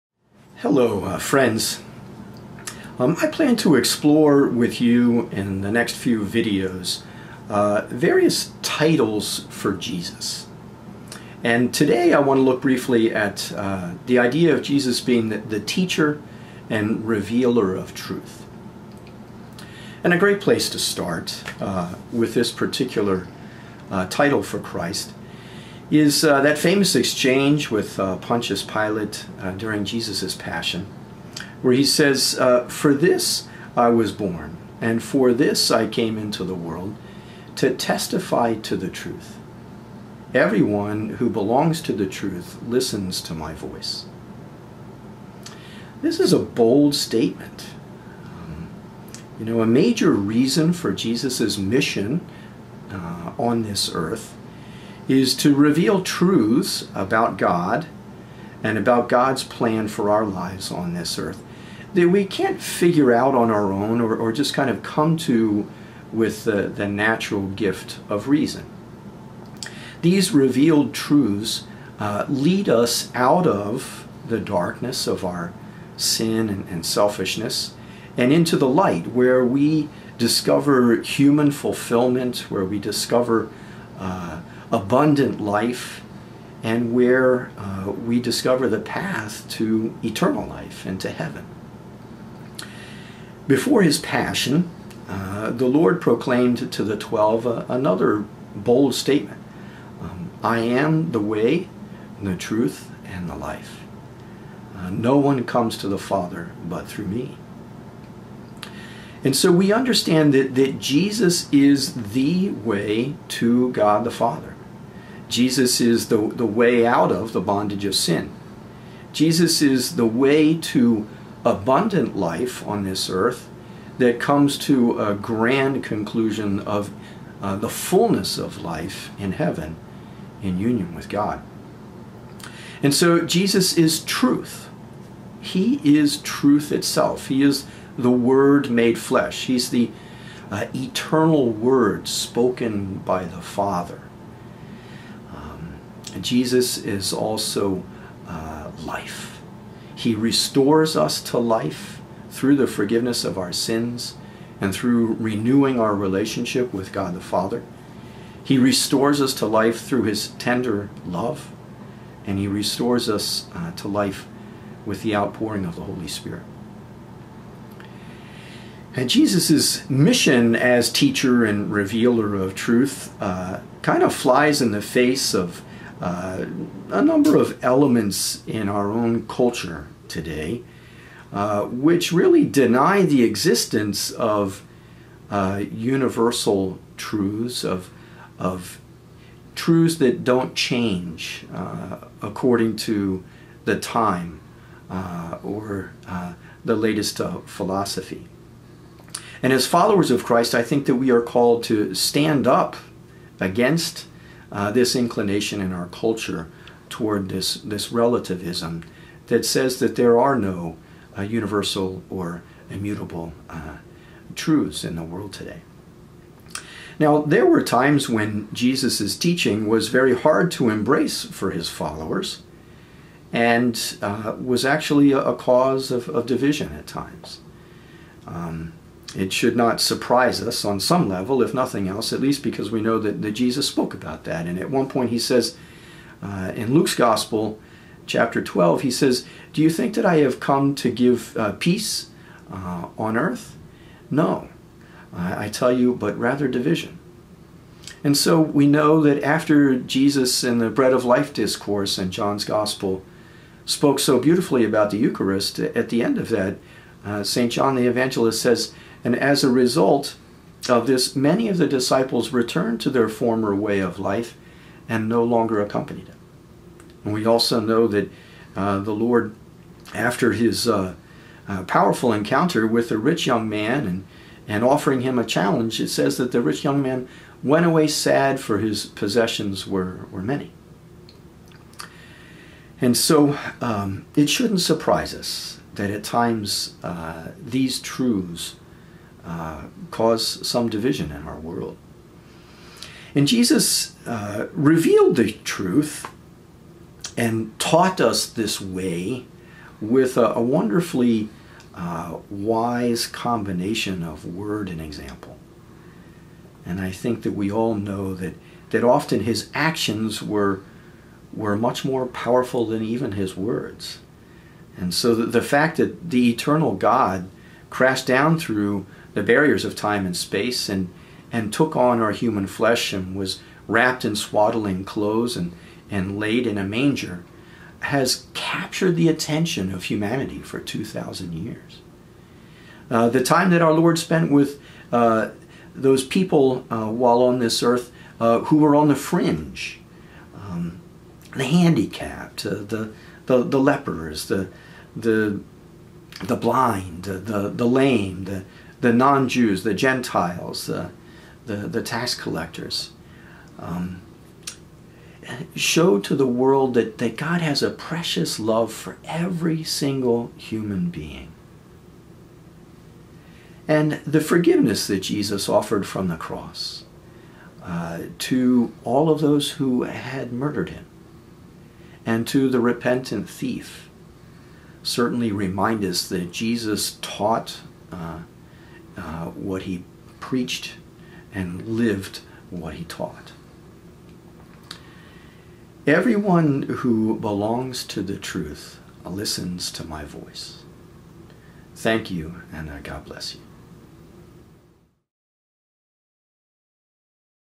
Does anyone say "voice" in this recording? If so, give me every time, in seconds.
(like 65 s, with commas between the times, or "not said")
43 s, 390 s.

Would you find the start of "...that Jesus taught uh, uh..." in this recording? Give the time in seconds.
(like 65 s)
376 s.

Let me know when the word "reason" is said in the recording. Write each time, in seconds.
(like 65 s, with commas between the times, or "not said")
50 s, 68 s.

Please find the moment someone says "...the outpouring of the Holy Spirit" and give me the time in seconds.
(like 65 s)
165 s.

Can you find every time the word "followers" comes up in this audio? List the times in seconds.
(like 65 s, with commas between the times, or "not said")
199 s, 221 s.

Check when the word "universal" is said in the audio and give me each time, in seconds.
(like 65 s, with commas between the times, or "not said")
185 s, 211 s.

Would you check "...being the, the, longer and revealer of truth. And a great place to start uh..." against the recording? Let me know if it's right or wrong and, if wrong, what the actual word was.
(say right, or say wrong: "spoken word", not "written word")
wrong: "teacher", not "longer".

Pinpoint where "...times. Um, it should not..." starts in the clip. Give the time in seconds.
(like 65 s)
226 s.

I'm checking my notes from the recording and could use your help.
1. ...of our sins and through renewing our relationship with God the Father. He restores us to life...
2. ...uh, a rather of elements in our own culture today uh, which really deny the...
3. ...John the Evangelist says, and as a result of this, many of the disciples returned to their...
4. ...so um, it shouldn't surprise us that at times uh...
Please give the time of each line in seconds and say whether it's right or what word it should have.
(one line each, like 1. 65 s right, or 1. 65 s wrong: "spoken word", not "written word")
1. 153 s right
2. 176 s wrong: "number", not "rather"
3. 257 s right
4. 282 s right.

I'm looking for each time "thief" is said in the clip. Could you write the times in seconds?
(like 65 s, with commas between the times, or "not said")
373 s.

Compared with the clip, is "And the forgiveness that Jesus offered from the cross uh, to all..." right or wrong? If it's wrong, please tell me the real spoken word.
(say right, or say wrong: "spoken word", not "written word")
right.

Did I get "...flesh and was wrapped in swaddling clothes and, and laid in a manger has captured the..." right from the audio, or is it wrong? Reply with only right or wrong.
right.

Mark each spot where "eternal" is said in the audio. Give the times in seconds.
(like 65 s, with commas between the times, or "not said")
90 s, 140 s, 316 s.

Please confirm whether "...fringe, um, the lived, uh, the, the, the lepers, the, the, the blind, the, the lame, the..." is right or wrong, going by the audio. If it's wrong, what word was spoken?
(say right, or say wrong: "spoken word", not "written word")
wrong: "handicapped", not "lived".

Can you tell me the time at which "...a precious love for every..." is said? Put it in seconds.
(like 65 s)
357 s.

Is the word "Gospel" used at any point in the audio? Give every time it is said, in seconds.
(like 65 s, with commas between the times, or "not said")
236 s, 252 s.